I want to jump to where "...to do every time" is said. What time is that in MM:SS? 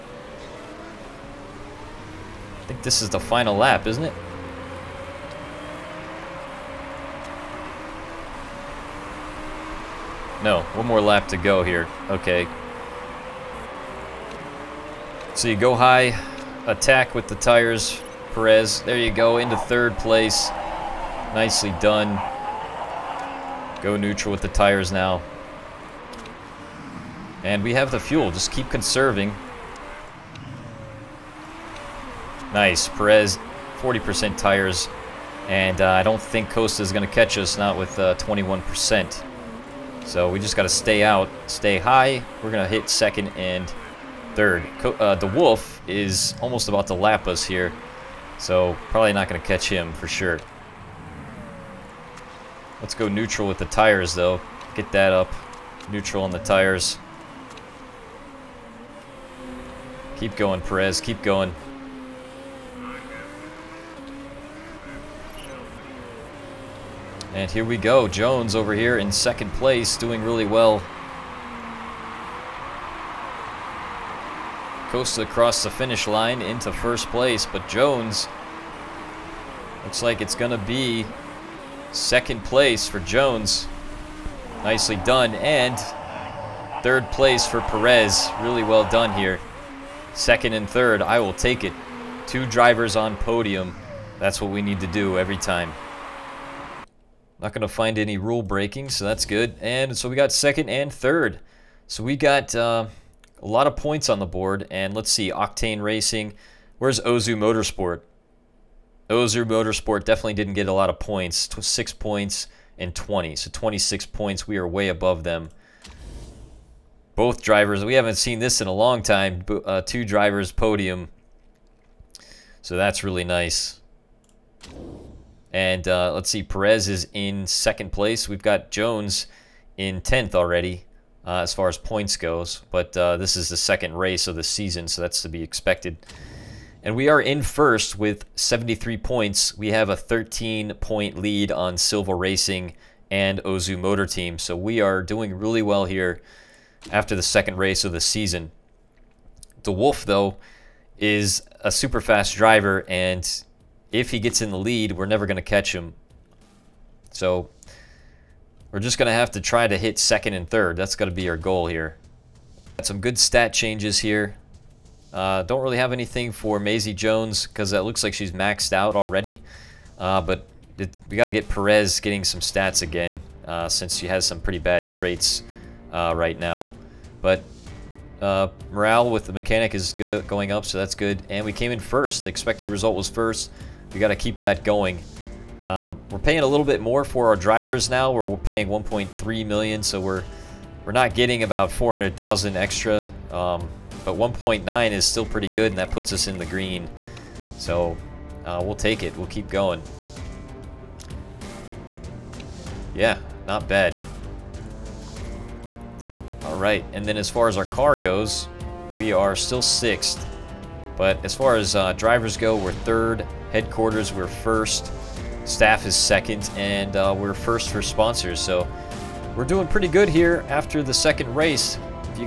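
01:34.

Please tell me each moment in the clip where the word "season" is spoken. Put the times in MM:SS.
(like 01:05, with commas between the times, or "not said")
02:14, 02:28.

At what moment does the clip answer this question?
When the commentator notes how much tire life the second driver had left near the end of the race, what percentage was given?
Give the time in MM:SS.
00:33.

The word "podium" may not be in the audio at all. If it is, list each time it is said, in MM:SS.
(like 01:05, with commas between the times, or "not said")
01:33, 02:00.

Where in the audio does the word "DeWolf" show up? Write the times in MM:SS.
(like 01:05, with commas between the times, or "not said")
00:45, 02:29.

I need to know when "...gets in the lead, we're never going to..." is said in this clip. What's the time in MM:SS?
02:34.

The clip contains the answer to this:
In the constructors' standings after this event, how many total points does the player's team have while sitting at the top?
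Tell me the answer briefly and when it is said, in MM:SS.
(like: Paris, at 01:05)
73, at 02:18.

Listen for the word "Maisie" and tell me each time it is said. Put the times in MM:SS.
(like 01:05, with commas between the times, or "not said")
02:46.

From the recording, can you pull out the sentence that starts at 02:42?
Got some good stat changes here.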